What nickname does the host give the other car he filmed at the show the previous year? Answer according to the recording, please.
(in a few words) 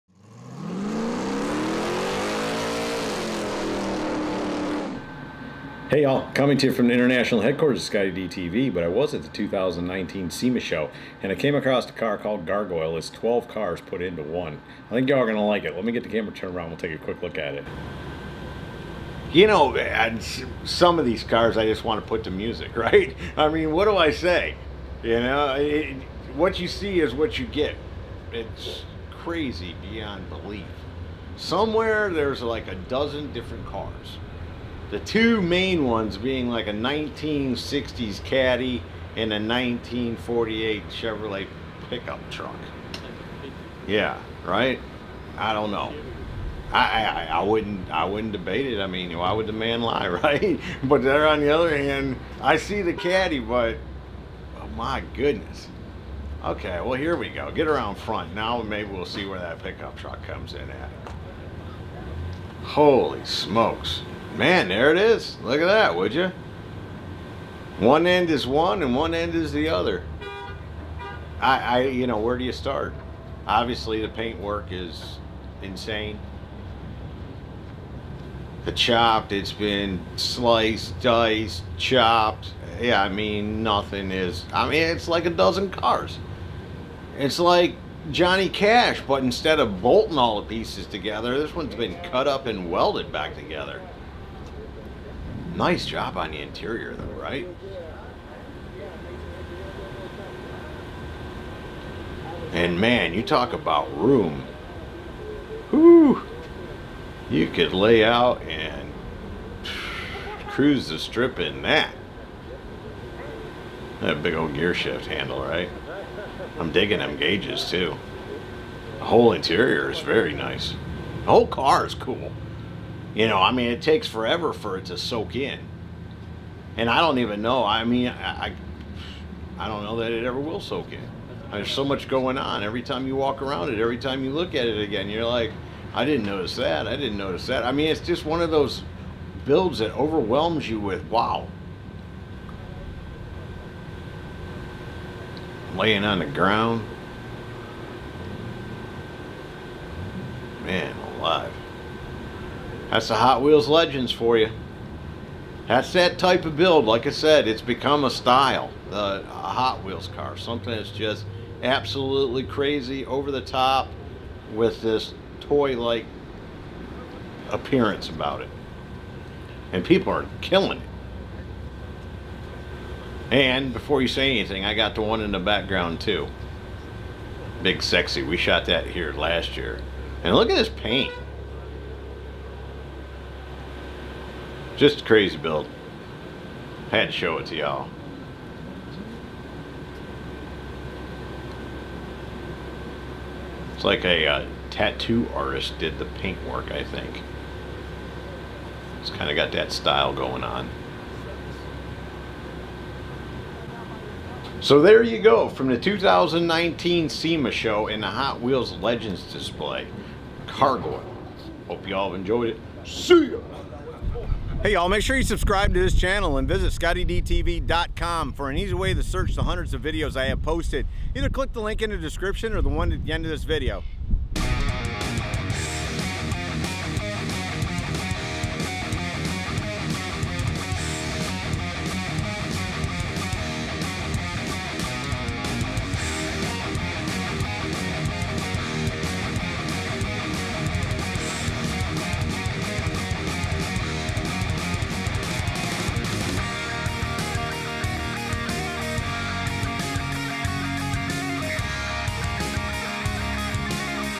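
Big Sexy.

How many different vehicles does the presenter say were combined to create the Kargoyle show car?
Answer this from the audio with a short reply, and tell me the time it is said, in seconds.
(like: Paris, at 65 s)
12, at 13 s.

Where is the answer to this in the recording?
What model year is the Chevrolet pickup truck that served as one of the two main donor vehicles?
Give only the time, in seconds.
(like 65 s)
39 s.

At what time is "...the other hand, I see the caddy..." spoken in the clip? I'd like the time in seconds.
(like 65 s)
51 s.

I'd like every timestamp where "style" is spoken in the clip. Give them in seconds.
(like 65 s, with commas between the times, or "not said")
158 s, 199 s.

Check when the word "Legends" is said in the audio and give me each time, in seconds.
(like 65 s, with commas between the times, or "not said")
153 s, 208 s.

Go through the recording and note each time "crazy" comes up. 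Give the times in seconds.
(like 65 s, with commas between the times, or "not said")
29 s, 162 s, 185 s.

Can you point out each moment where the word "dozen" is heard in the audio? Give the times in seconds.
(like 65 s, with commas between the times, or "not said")
32 s, 85 s.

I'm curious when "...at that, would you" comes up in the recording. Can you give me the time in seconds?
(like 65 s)
65 s.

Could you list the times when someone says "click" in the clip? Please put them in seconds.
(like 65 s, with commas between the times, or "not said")
221 s.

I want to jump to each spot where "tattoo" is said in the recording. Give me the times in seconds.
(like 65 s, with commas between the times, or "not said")
194 s.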